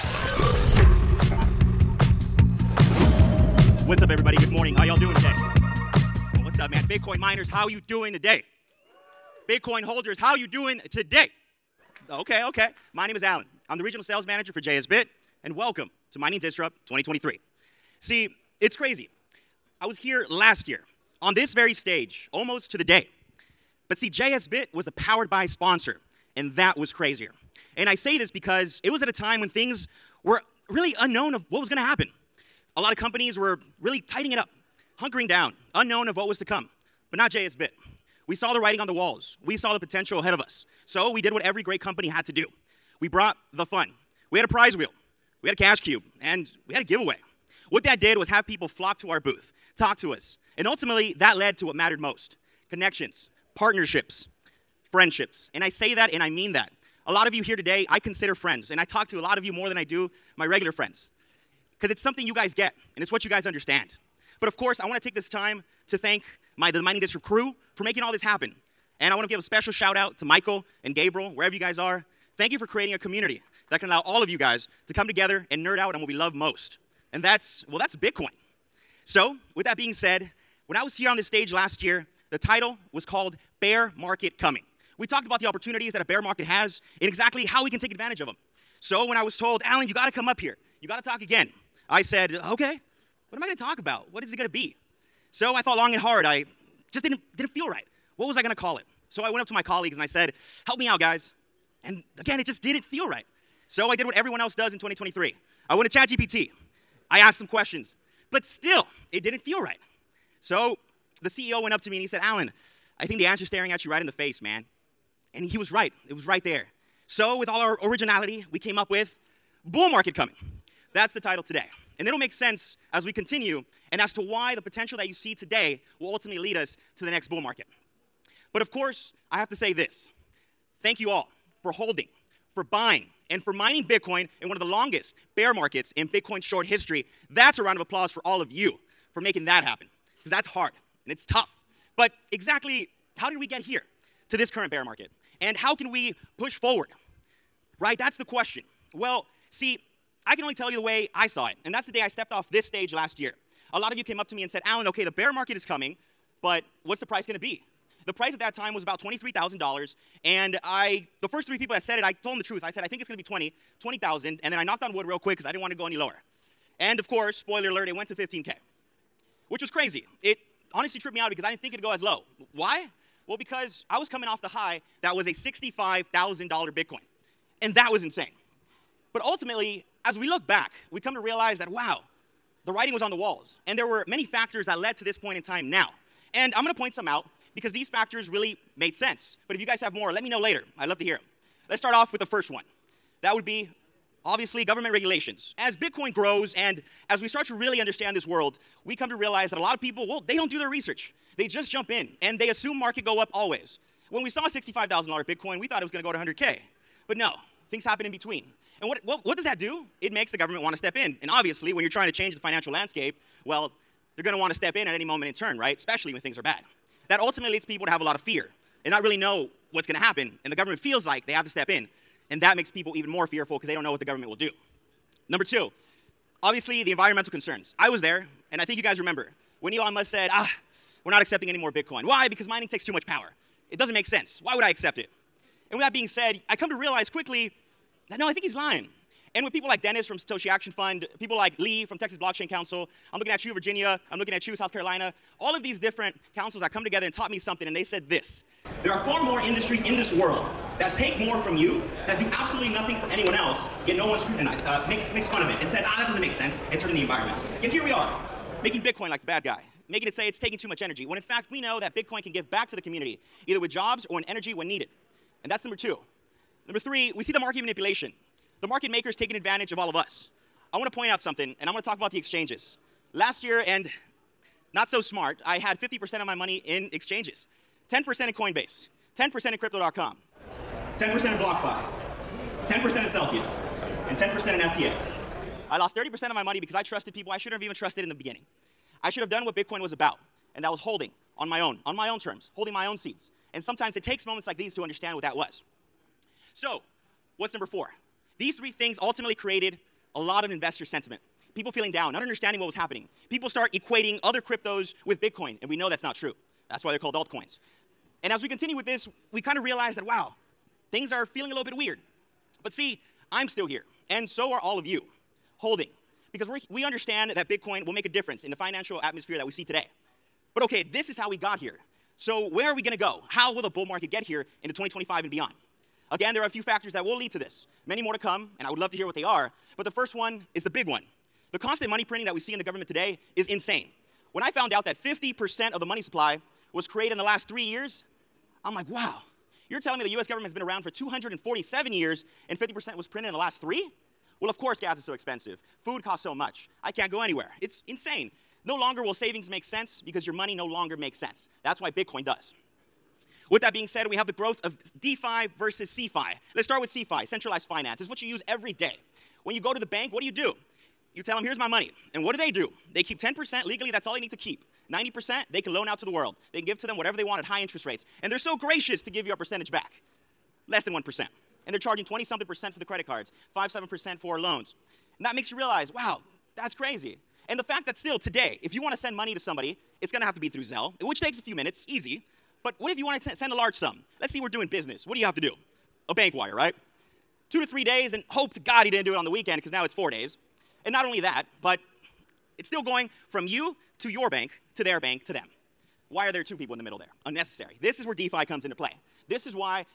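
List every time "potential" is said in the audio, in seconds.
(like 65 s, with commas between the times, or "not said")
39 s, 124 s.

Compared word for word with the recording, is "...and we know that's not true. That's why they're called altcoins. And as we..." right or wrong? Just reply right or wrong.
right.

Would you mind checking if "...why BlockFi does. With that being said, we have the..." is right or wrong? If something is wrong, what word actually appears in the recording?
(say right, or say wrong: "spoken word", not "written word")
wrong: "Bitcoin", not "BlockFi".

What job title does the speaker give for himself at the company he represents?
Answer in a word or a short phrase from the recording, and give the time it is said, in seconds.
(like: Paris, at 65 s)
Regional sales manager, at 13 s.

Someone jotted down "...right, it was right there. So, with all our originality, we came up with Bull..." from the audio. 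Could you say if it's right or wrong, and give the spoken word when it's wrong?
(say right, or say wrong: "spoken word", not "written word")
right.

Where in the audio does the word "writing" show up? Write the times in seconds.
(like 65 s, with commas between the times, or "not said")
38 s, 182 s.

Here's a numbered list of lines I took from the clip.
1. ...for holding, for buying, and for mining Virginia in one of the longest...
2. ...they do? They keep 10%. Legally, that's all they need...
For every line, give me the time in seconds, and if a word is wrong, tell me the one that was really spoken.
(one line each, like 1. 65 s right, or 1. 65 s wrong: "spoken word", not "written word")
1. 131 s wrong: "Bitcoin", not "Virginia"
2. 362 s right.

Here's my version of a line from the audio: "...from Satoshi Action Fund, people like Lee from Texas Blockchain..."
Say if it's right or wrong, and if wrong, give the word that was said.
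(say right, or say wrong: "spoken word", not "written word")
right.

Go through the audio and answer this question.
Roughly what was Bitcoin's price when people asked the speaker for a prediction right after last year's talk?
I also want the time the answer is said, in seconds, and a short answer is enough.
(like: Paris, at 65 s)
$23,000, at 158 s.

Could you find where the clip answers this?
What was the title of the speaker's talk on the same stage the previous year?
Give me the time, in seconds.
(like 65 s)
83 s.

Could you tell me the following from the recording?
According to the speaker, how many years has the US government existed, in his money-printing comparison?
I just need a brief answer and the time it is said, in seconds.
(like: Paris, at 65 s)
247, at 340 s.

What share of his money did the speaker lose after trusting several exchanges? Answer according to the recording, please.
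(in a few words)
30%.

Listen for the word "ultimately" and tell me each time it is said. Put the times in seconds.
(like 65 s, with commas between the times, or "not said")
50 s, 126 s, 179 s, 217 s, 299 s.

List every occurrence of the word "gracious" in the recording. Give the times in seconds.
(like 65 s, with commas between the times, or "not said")
368 s.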